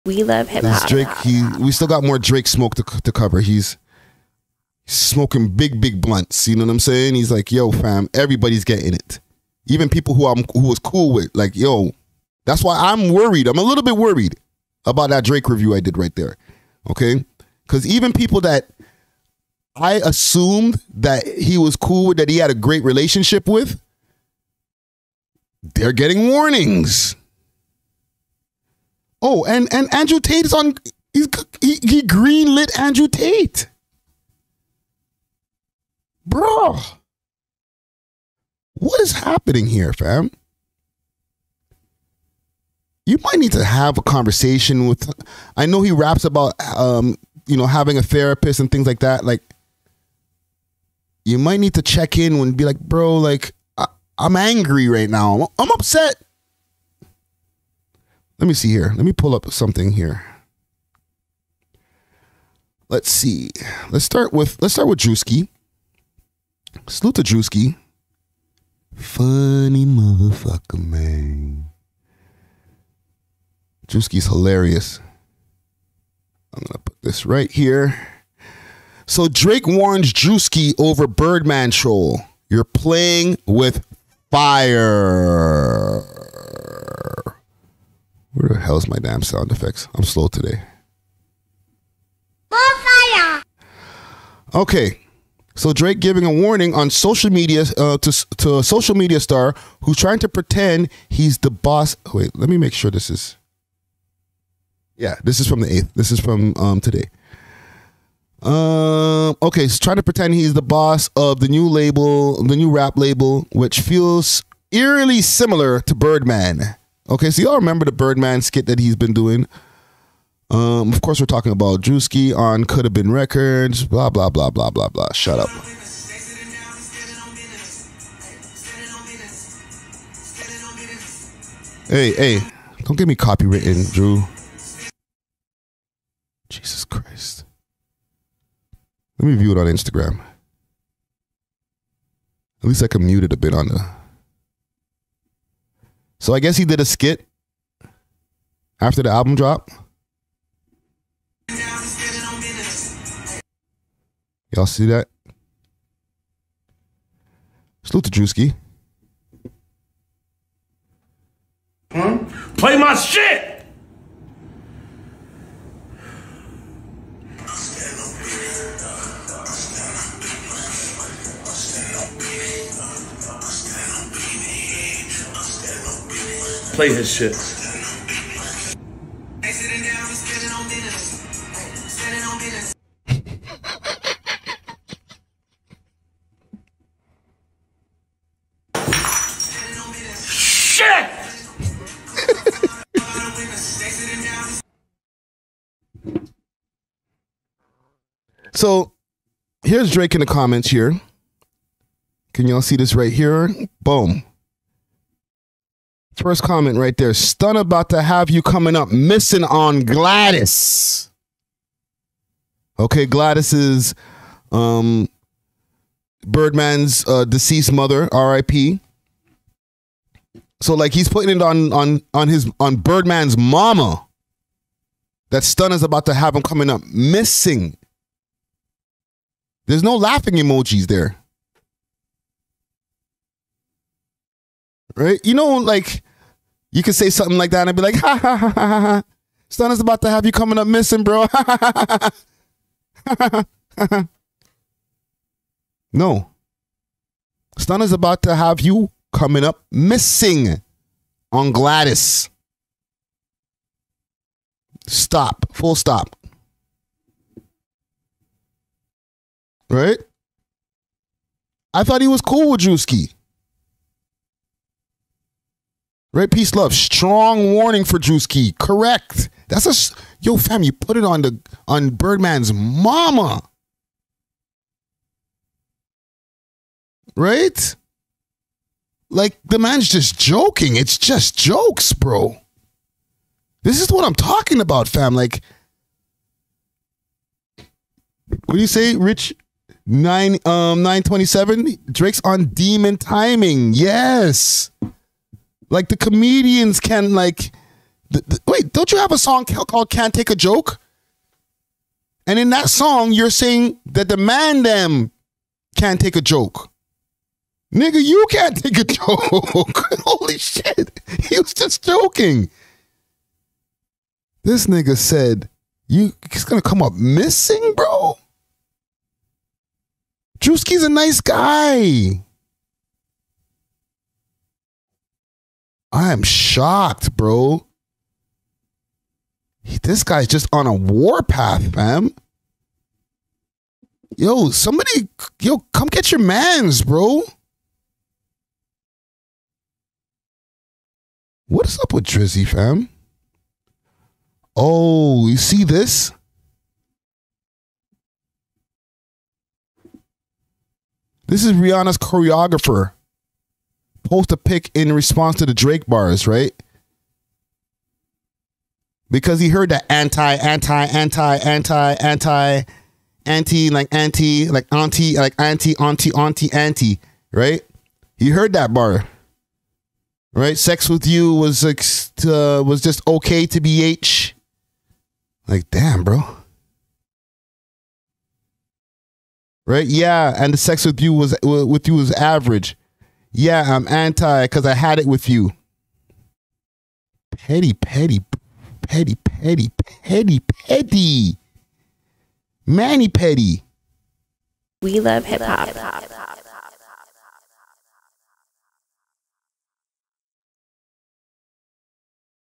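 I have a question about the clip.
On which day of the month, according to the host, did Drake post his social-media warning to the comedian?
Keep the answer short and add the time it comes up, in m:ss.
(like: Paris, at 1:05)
the 8th, at 1:45.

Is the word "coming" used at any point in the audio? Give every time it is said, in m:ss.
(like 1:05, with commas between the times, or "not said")
3:28, 3:46, 4:00, 4:09.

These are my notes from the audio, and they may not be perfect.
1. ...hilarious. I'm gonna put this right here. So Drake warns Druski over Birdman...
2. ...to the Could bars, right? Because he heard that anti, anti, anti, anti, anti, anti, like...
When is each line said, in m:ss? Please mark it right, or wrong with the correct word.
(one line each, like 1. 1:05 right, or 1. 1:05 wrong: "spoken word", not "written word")
1. 1:14 right
2. 5:55 wrong: "Drake", not "Could".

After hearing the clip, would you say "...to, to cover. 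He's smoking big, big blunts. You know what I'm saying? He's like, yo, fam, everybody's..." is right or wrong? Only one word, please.
right.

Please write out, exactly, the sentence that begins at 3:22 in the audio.
Can y'all see this right here?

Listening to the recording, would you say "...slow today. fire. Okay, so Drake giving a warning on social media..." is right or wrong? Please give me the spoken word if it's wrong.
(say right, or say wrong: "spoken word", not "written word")
right.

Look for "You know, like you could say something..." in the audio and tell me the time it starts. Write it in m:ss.
3:55.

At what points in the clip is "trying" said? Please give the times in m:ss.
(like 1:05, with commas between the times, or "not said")
1:39, 1:49.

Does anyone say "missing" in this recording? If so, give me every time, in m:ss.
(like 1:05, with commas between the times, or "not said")
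3:28, 3:46, 4:00, 4:09, 5:16.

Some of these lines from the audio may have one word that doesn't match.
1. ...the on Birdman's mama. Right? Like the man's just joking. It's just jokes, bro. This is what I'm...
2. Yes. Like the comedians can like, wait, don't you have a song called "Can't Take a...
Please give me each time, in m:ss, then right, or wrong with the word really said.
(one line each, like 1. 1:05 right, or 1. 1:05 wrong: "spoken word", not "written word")
1. 4:31 right
2. 4:53 right.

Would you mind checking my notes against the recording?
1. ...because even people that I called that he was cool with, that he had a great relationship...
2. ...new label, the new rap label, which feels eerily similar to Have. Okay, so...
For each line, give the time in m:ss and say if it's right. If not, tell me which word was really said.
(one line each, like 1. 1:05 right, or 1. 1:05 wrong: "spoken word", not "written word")
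1. 0:17 wrong: "assumed", not "called"
2. 1:51 wrong: "Birdman", not "Have".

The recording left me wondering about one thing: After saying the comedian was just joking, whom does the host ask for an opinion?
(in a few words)
Rich.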